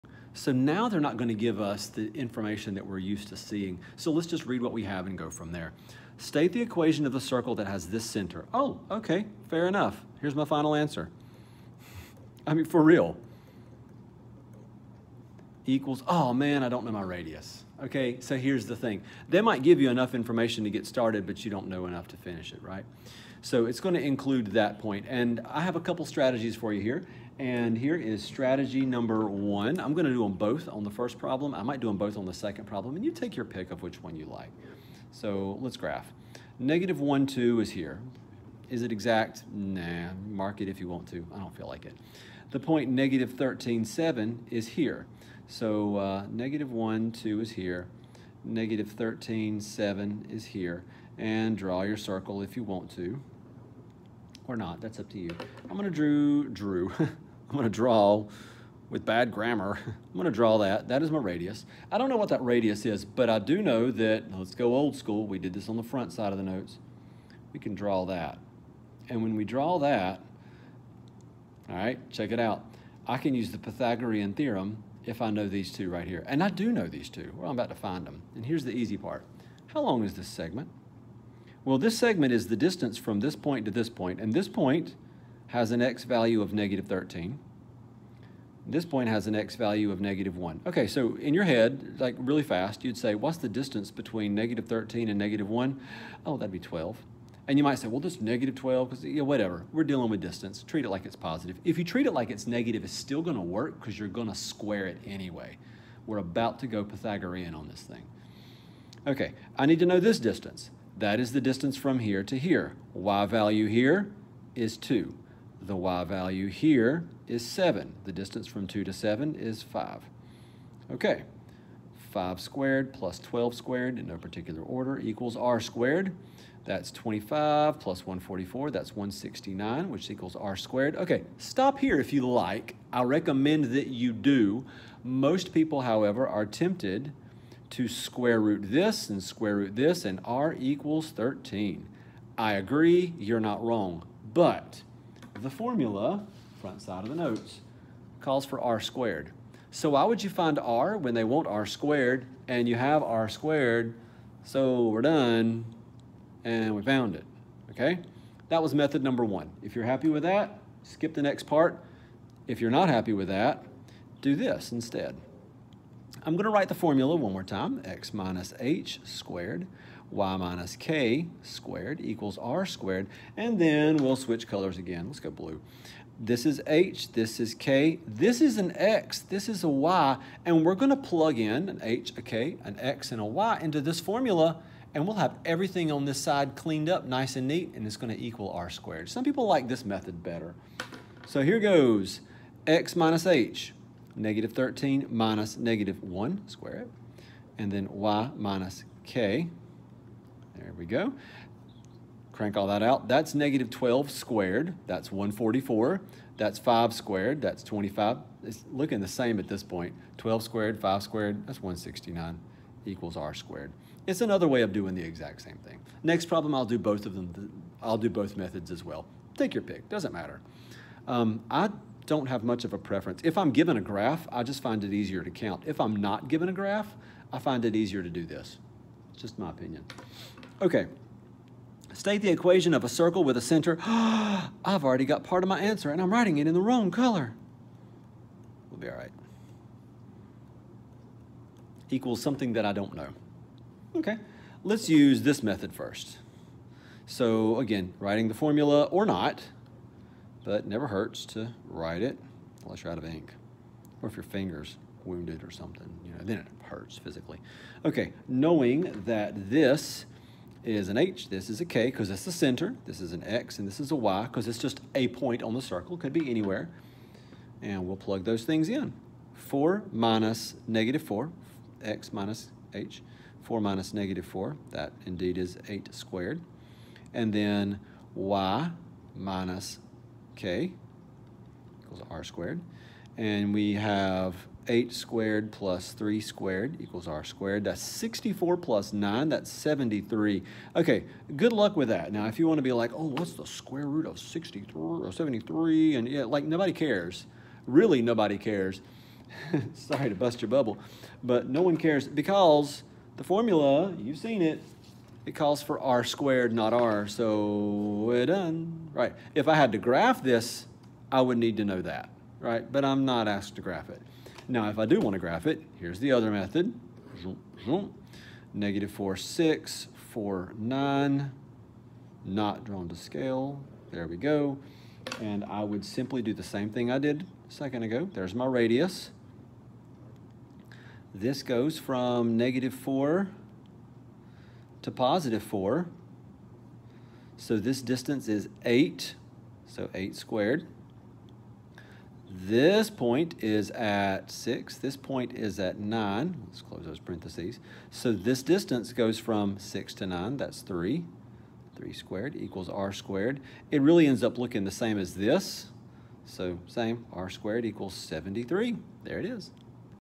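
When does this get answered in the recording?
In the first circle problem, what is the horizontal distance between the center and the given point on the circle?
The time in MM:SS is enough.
01:36.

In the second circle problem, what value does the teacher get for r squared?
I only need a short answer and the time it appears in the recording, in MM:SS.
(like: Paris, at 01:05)
73, at 04:49.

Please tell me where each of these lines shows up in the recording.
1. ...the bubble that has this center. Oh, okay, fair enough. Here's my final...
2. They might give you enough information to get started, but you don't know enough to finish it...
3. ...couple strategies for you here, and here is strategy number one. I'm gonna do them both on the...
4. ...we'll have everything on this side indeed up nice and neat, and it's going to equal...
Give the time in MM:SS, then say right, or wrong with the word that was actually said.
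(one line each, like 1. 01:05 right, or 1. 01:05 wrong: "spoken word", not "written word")
1. 00:07 wrong: "circle", not "bubble"
2. 00:19 right
3. 00:25 right
4. 03:05 wrong: "cleaned", not "indeed".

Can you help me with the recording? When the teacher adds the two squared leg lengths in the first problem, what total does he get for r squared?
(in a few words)
169.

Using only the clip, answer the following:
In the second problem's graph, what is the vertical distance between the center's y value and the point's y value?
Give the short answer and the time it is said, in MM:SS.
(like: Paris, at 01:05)
3, at 05:50.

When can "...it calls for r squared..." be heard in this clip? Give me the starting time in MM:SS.
05:05.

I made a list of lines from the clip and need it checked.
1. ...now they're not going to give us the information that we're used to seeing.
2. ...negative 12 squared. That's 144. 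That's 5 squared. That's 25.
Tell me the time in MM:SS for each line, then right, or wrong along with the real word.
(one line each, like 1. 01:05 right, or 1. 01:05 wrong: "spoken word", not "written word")
1. 00:00 right
2. 03:23 right.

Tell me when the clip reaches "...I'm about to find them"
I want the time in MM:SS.
01:17.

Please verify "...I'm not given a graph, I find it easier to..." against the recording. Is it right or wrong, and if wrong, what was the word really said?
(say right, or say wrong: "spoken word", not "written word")
right.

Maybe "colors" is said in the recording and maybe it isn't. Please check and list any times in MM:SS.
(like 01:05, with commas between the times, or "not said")
02:54, 03:56.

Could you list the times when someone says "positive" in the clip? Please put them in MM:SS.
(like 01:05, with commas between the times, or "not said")
01:41, 05:34.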